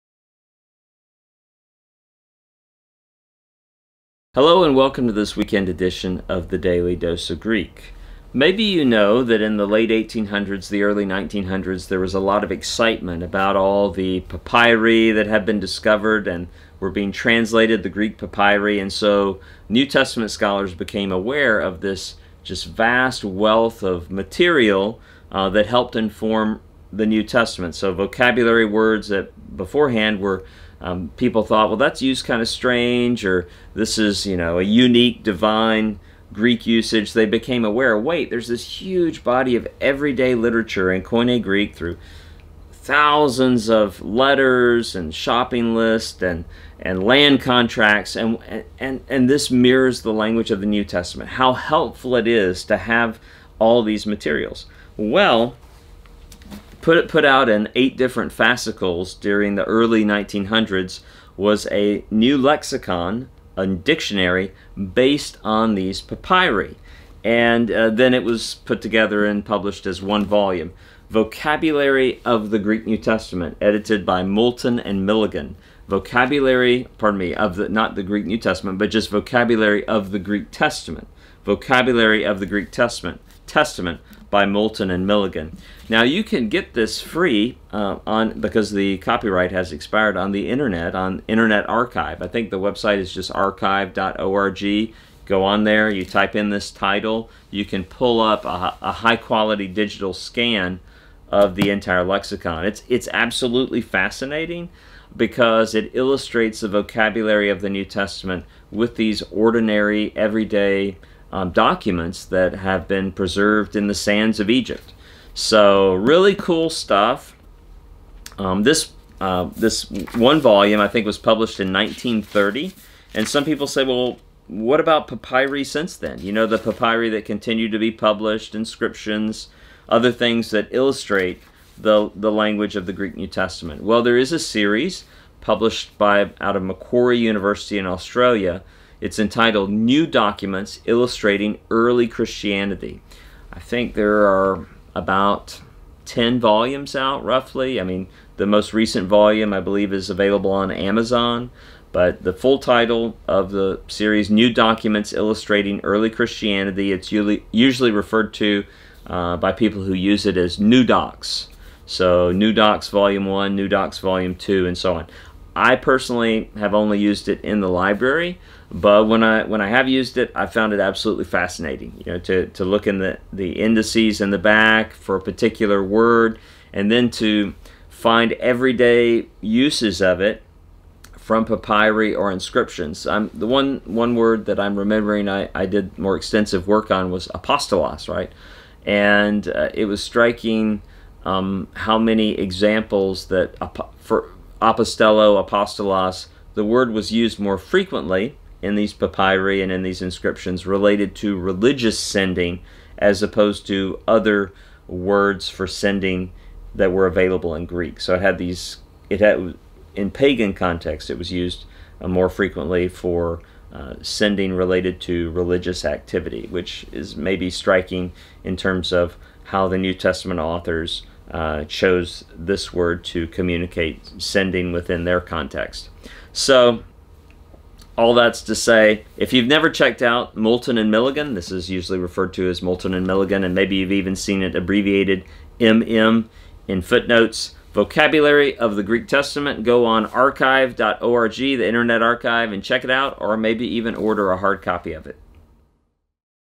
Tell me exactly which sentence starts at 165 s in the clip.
I personally have only used it in the library, but when I when I have used it, I found it absolutely fascinating.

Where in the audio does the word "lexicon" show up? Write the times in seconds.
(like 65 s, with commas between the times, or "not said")
62 s, 102 s.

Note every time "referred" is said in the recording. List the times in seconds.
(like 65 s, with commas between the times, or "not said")
157 s, 231 s.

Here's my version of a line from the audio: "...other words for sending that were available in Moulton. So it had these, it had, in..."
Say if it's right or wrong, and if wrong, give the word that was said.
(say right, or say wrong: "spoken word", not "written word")
wrong: "Greek", not "Moulton".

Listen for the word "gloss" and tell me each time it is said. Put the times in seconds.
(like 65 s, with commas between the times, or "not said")
not said.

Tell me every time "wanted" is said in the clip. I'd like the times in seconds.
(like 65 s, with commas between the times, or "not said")
not said.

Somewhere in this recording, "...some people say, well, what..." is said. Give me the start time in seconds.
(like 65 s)
123 s.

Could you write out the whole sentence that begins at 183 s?
I'm, the one one word that I'm remembering I, I did more extensive work on was apostolos, right?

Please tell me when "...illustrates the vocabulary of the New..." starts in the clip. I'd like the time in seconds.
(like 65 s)
105 s.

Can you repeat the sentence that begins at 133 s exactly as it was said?
Well, there is a series published by out of Macquarie University in Australia it's entitled New Documents Illustrating Early Christianity.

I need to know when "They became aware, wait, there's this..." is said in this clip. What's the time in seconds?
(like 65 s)
37 s.